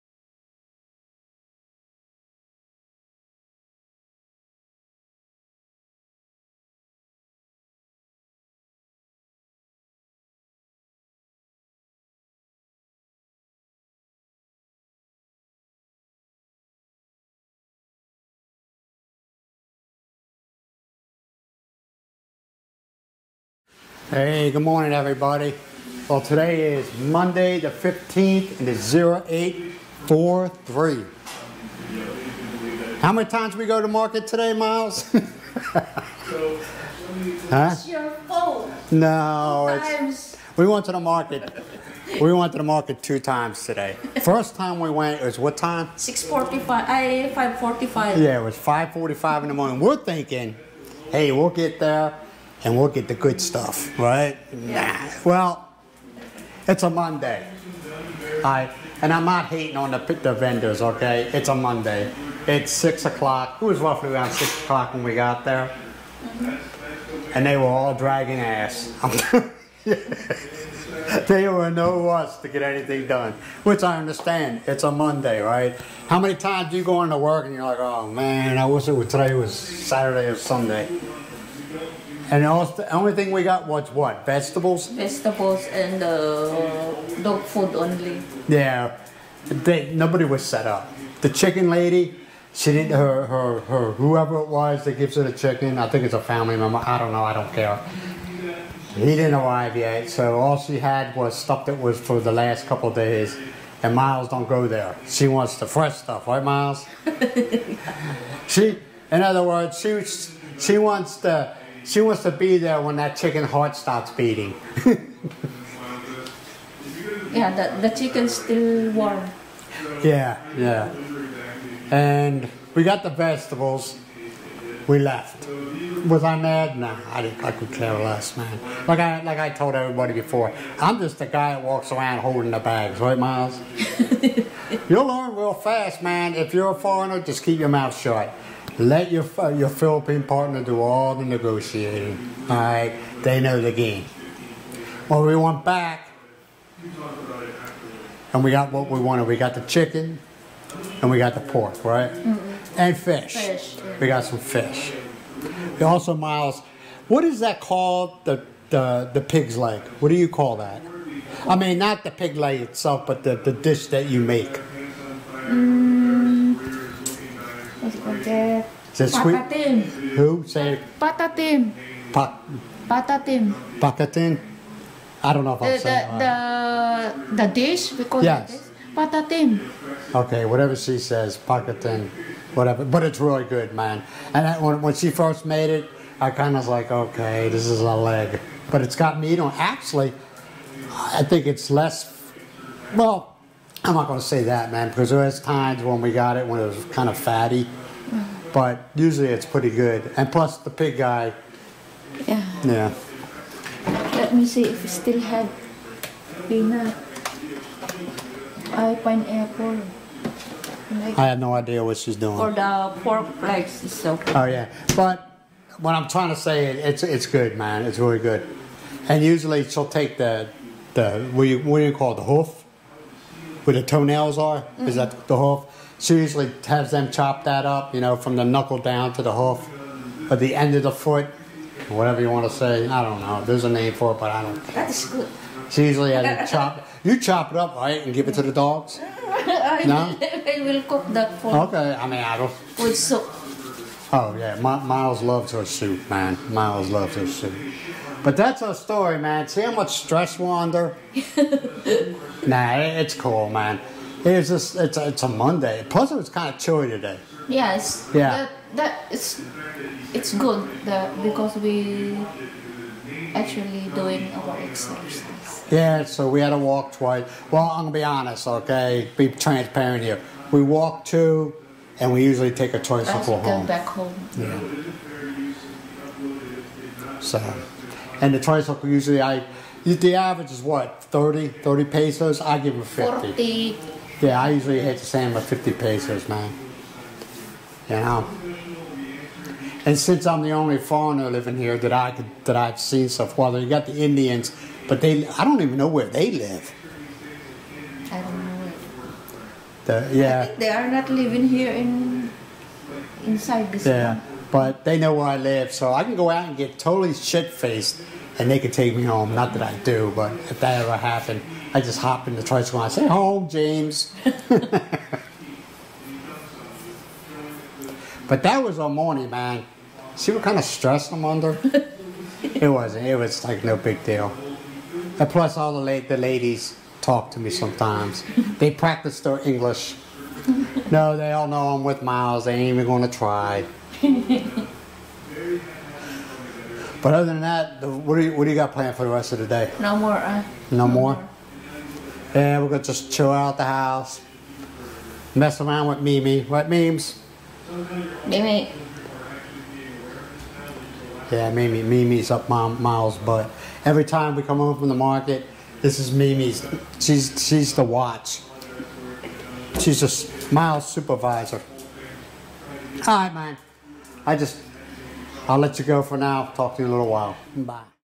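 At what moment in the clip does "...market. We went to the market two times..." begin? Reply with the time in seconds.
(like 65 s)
40 s.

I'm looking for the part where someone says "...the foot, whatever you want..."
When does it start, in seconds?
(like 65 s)
230 s.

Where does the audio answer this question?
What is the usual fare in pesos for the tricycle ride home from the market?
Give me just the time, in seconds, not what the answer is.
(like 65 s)
281 s.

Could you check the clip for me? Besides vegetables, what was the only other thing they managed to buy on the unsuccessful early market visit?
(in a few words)
Dog food.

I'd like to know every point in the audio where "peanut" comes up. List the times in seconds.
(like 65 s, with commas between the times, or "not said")
206 s.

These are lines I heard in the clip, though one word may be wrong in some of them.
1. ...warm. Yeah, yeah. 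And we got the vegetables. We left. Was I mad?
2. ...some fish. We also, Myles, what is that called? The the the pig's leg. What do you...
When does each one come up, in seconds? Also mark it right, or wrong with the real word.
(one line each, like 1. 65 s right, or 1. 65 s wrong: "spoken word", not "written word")
1. 118 s right
2. 154 s right.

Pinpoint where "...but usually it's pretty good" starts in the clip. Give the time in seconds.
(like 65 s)
198 s.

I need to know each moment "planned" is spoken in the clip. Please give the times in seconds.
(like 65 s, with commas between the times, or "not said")
338 s.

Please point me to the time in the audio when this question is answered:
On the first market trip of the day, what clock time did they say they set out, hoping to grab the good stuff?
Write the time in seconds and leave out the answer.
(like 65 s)
48 s.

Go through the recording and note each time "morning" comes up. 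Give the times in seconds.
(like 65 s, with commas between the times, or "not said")
24 s, 49 s, 318 s.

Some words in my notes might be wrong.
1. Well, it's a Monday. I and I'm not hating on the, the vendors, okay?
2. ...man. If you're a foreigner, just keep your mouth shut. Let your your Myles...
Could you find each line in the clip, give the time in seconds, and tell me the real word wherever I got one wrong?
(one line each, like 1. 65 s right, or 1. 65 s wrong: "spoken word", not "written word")
1. 55 s right
2. 136 s wrong: "Philippine", not "Myles".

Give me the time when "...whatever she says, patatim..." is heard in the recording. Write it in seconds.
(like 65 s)
180 s.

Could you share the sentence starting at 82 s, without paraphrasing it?
And the only thing we got was what?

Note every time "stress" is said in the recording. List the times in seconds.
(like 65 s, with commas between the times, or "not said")
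249 s, 320 s.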